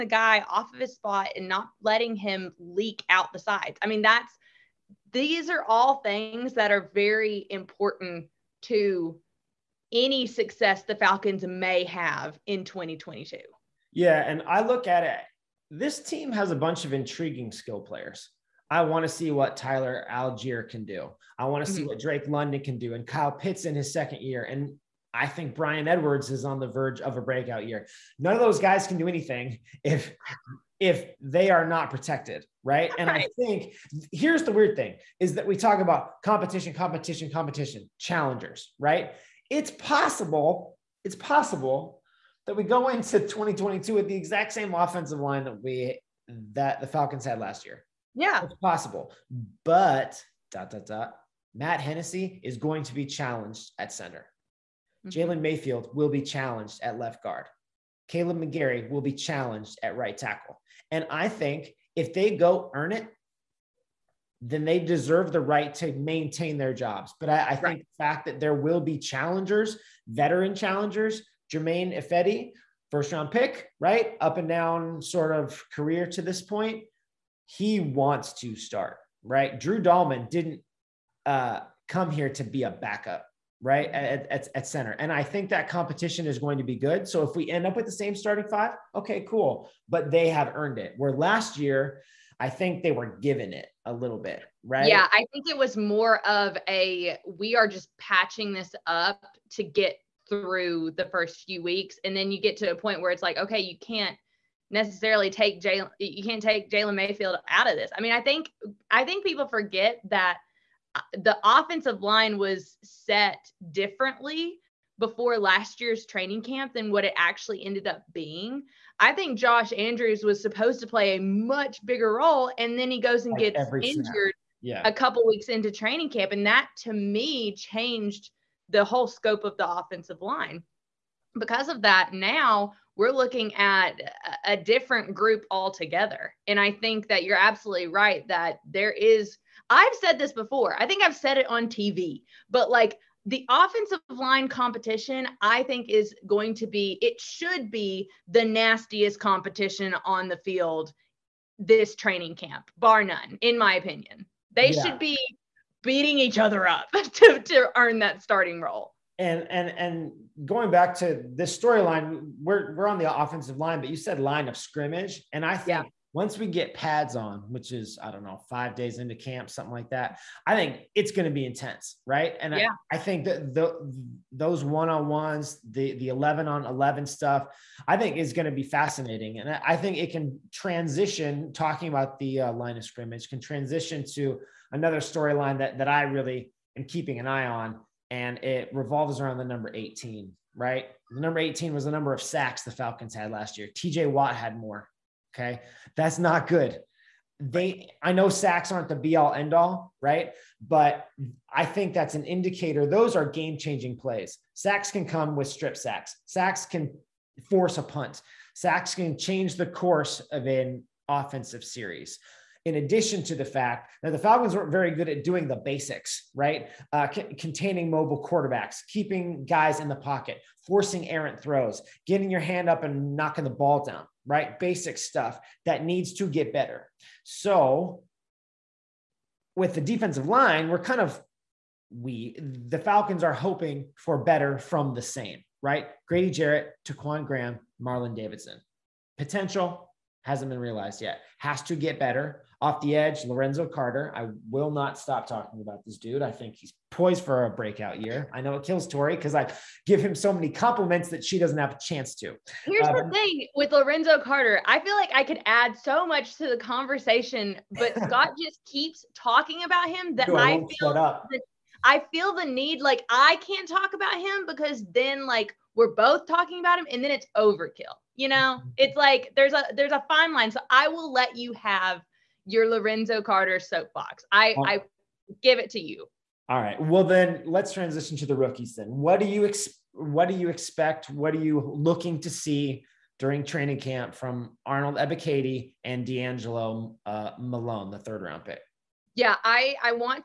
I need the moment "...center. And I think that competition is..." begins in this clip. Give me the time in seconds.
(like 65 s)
84 s.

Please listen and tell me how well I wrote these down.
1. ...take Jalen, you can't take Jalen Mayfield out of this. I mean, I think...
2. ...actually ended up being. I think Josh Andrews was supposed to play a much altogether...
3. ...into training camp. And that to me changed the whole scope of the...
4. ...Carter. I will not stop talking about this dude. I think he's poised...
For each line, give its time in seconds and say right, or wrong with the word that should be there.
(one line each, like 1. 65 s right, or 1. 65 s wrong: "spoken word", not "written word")
1. 105 s right
2. 117 s wrong: "bigger", not "altogether"
3. 125 s right
4. 243 s right.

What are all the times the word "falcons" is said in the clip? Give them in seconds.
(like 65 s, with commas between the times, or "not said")
10 s, 46 s, 192 s, 214 s, 232 s.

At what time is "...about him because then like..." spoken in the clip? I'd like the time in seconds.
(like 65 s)
263 s.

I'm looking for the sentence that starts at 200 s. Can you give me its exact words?
But I think that's an indicator.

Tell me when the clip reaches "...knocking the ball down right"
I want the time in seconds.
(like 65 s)
223 s.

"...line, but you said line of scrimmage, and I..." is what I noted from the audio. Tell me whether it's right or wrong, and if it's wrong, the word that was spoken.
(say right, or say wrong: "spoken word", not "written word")
right.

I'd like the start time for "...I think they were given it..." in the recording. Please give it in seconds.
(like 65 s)
92 s.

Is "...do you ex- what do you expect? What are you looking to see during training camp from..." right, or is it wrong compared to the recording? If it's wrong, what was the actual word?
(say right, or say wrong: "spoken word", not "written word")
right.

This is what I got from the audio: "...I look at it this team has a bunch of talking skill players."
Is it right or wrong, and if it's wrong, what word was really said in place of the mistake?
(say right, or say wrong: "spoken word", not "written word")
wrong: "intriguing", not "talking".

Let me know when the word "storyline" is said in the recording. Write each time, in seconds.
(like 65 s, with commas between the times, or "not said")
161 s, 185 s.